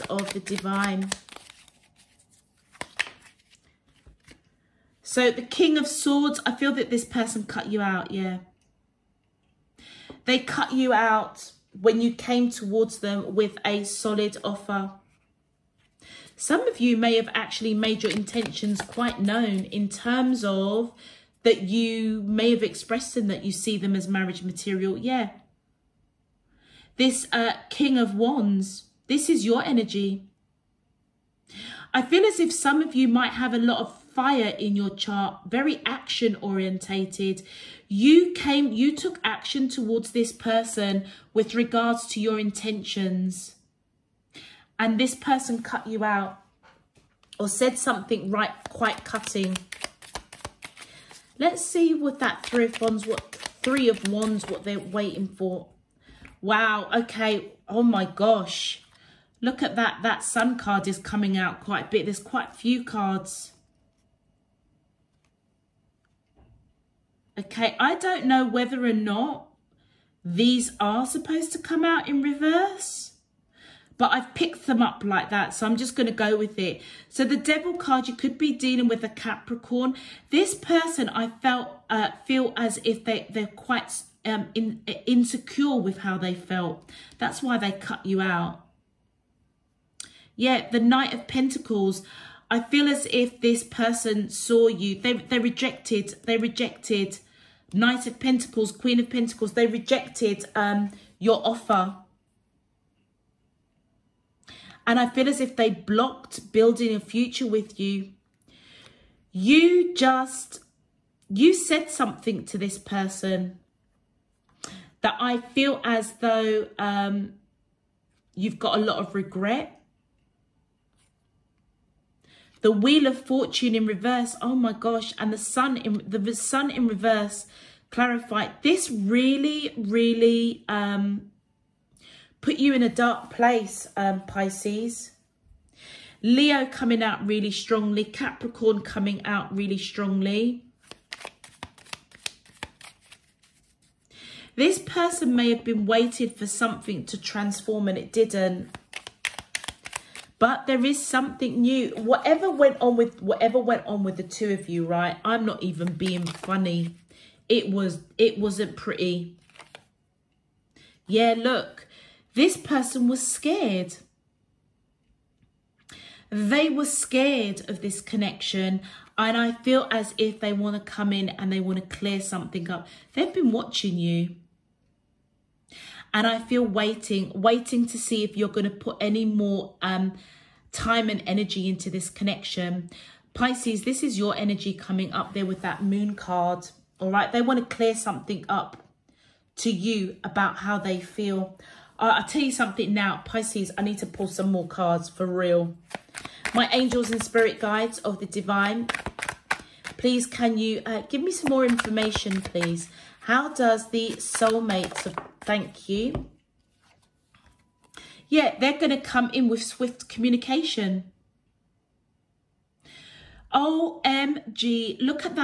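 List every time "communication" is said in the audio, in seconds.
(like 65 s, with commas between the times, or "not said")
210 s.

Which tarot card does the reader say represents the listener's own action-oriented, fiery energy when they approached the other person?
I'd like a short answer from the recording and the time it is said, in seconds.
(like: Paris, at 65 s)
King of Wands, at 27 s.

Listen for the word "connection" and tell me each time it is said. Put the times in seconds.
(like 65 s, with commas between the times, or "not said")
167 s, 182 s.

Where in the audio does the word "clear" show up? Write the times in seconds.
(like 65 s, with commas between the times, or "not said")
171 s, 187 s.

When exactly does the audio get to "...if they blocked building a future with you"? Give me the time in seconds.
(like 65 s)
105 s.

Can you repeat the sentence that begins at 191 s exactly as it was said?
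I'll tell you something now, Pisces, I need to pull some more cards for real.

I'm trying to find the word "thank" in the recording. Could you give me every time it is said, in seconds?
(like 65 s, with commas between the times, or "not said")
205 s.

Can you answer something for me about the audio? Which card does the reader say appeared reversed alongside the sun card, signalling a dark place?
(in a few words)
Wheel of Fortune.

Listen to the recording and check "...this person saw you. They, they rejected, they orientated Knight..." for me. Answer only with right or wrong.
wrong.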